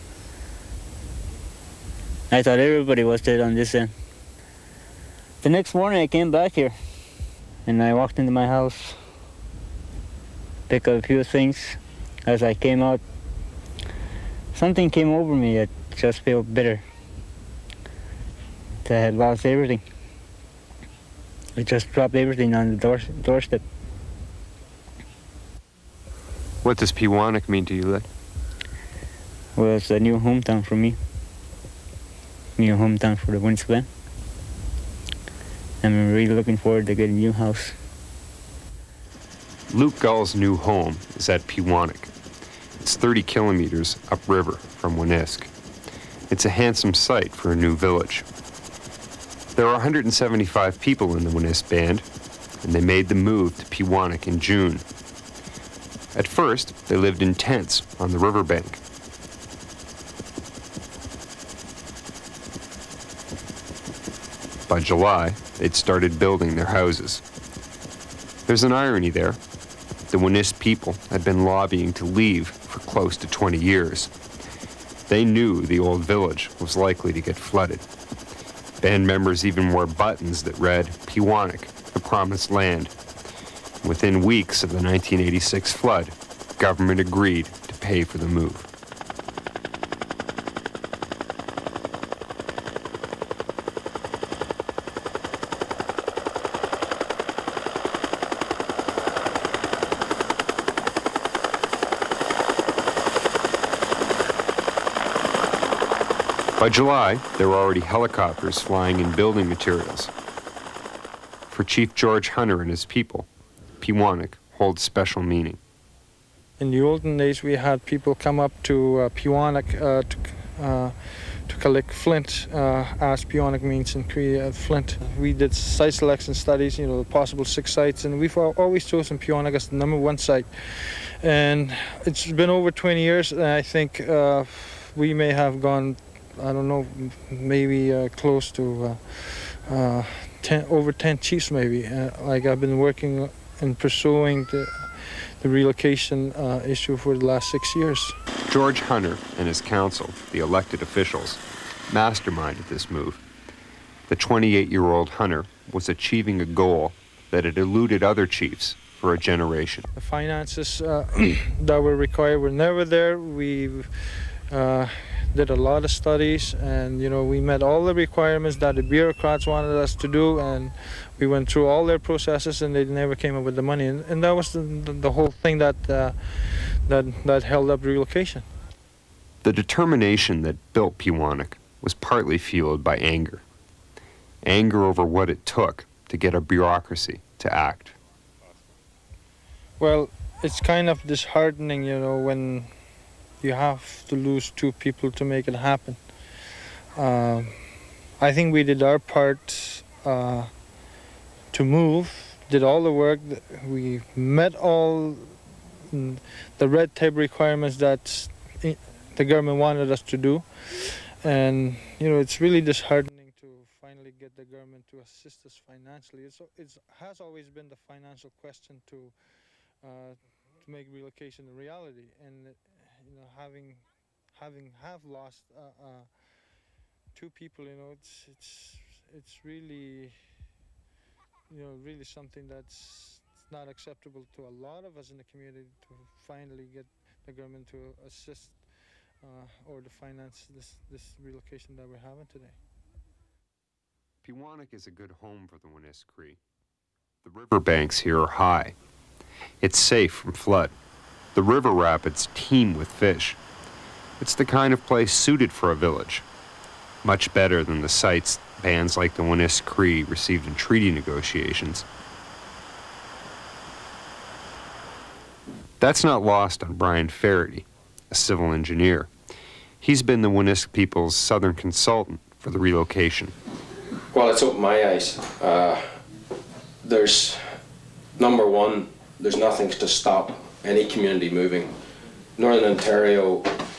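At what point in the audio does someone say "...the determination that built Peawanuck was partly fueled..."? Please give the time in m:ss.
2:59.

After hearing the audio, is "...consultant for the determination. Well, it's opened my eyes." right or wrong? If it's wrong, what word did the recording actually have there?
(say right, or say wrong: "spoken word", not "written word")
wrong: "relocation", not "determination".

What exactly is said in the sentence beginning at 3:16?
Um, I think we did our part uh, to move, did all the work.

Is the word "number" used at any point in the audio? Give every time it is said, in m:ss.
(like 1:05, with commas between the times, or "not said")
2:09, 4:38.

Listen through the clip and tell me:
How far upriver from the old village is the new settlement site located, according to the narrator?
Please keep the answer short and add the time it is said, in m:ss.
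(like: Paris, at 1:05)
30 kilometers, at 0:42.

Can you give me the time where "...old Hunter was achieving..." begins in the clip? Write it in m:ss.
2:34.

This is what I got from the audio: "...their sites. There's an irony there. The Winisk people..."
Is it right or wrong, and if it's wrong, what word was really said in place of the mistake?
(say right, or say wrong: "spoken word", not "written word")
wrong: "houses", not "sites".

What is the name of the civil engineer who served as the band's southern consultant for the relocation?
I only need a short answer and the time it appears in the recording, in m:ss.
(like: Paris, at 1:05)
Brian Faraday, at 4:26.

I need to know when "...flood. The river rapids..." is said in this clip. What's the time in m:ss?
4:10.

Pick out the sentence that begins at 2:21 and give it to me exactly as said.
Uh, like I've been working and pursuing the, the relocation uh, issue for the last six years.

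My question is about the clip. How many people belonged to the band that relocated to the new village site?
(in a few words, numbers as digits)
175.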